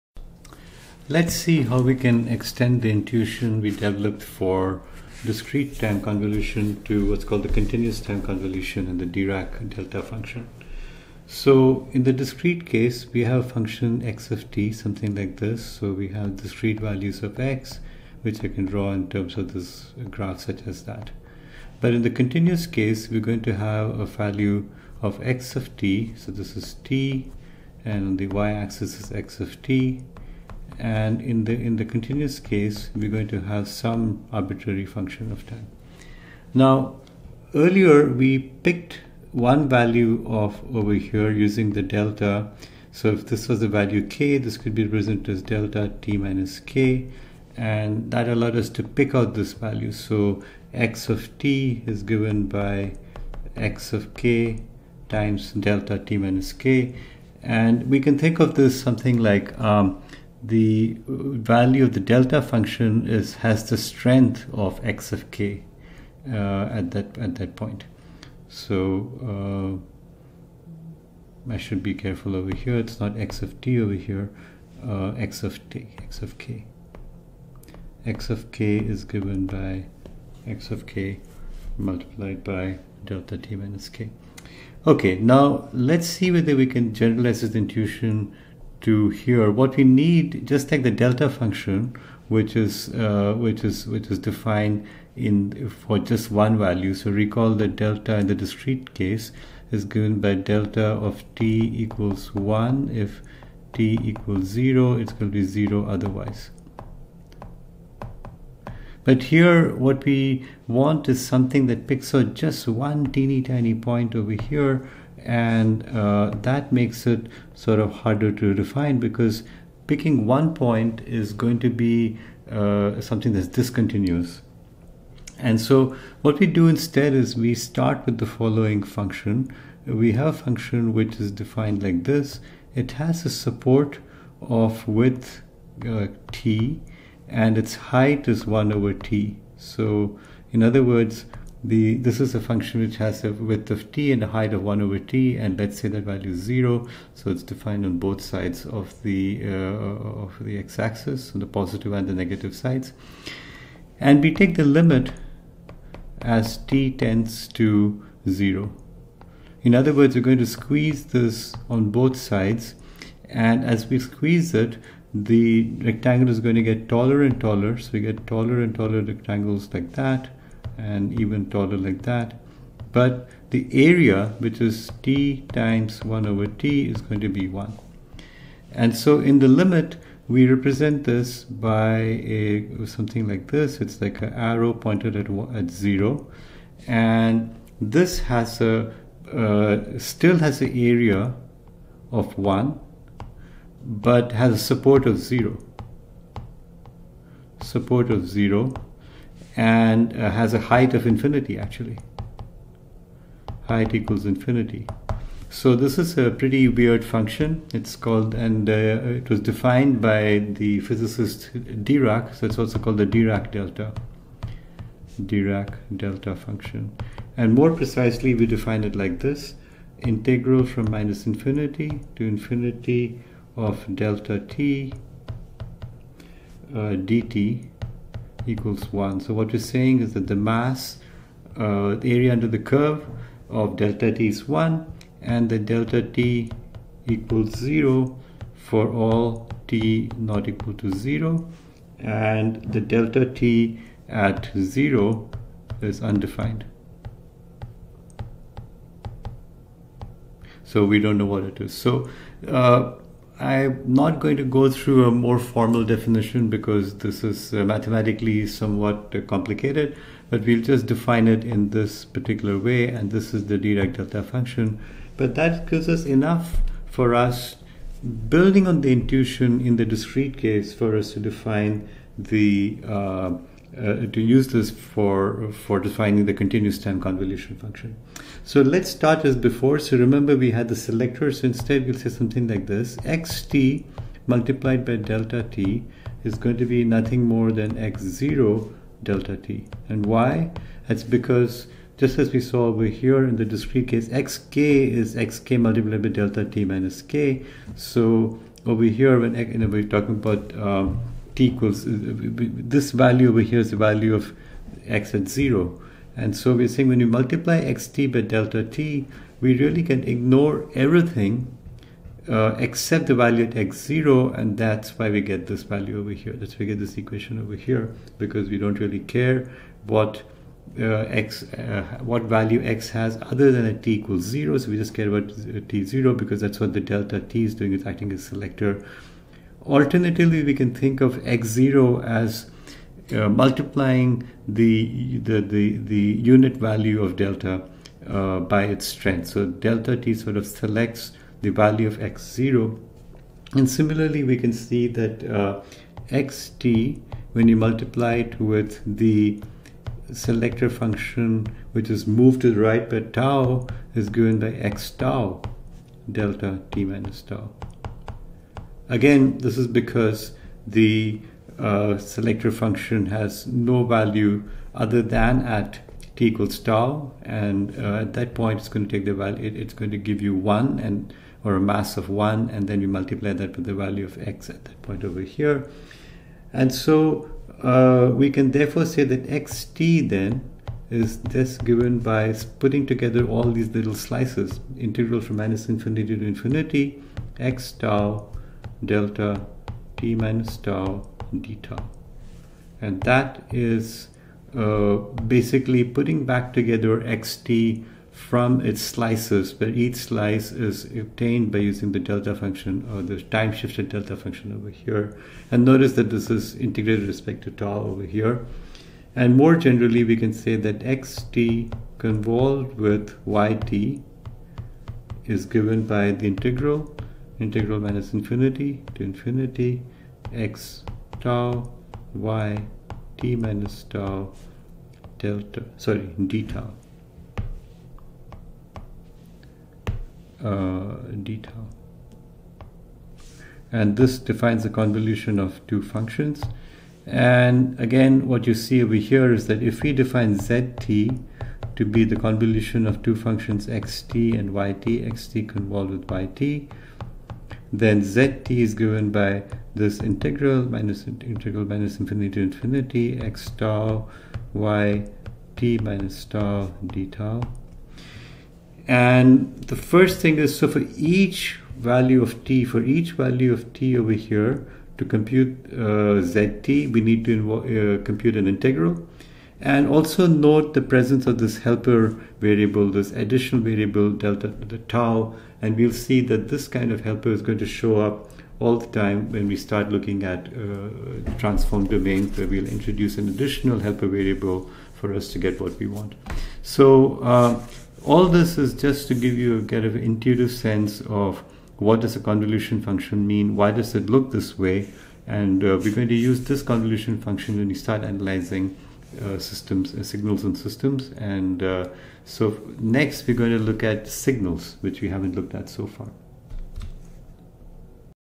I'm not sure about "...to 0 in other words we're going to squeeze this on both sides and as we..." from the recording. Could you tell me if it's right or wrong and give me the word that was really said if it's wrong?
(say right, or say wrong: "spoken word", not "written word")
right.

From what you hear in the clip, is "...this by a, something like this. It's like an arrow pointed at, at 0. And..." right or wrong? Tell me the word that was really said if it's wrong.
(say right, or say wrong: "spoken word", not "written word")
right.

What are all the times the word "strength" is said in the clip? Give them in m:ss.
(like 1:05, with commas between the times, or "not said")
1:03, 5:38.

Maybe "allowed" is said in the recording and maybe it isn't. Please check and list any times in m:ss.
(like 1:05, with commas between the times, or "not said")
0:48.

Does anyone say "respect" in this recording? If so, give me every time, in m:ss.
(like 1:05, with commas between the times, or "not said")
6:47.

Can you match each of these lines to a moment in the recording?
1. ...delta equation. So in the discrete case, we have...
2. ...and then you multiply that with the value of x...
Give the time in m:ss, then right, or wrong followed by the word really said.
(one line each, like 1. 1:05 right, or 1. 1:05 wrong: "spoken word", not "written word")
1. 0:09 wrong: "function", not "equation"
2. 6:12 right.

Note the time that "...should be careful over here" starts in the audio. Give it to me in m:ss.
1:11.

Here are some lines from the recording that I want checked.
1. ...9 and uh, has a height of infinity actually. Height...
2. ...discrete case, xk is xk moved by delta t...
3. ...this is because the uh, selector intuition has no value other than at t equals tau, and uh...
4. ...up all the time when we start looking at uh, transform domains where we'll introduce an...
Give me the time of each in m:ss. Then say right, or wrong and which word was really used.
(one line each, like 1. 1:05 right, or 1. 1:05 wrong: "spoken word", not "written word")
1. 3:18 wrong: "0", not "9"
2. 4:53 wrong: "multiplied", not "moved"
3. 5:59 wrong: "function", not "intuition"
4. 7:58 right.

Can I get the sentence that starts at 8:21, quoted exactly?
And uh, so next we're going to look at signals, which we haven't looked at so far.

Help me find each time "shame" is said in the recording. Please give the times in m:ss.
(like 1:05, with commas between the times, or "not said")
not said.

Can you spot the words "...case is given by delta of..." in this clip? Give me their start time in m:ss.
1:38.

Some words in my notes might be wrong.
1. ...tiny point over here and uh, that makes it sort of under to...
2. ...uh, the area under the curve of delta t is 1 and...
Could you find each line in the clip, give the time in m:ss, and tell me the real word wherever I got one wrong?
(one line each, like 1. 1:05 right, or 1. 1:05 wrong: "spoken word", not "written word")
1. 1:53 wrong: "harder", not "under"
2. 3:51 right.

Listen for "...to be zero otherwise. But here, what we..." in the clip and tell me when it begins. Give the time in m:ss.
1:45.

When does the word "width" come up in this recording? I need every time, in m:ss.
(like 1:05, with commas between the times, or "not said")
2:14, 2:23.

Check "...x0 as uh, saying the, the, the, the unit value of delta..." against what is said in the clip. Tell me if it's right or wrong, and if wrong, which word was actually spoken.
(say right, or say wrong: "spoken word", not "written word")
wrong: "multiplying", not "saying".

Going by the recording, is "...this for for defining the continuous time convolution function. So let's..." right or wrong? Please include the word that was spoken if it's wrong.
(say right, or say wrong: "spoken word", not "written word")
right.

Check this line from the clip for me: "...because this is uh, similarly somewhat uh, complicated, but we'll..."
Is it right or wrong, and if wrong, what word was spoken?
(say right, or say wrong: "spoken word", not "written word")
wrong: "mathematically", not "similarly".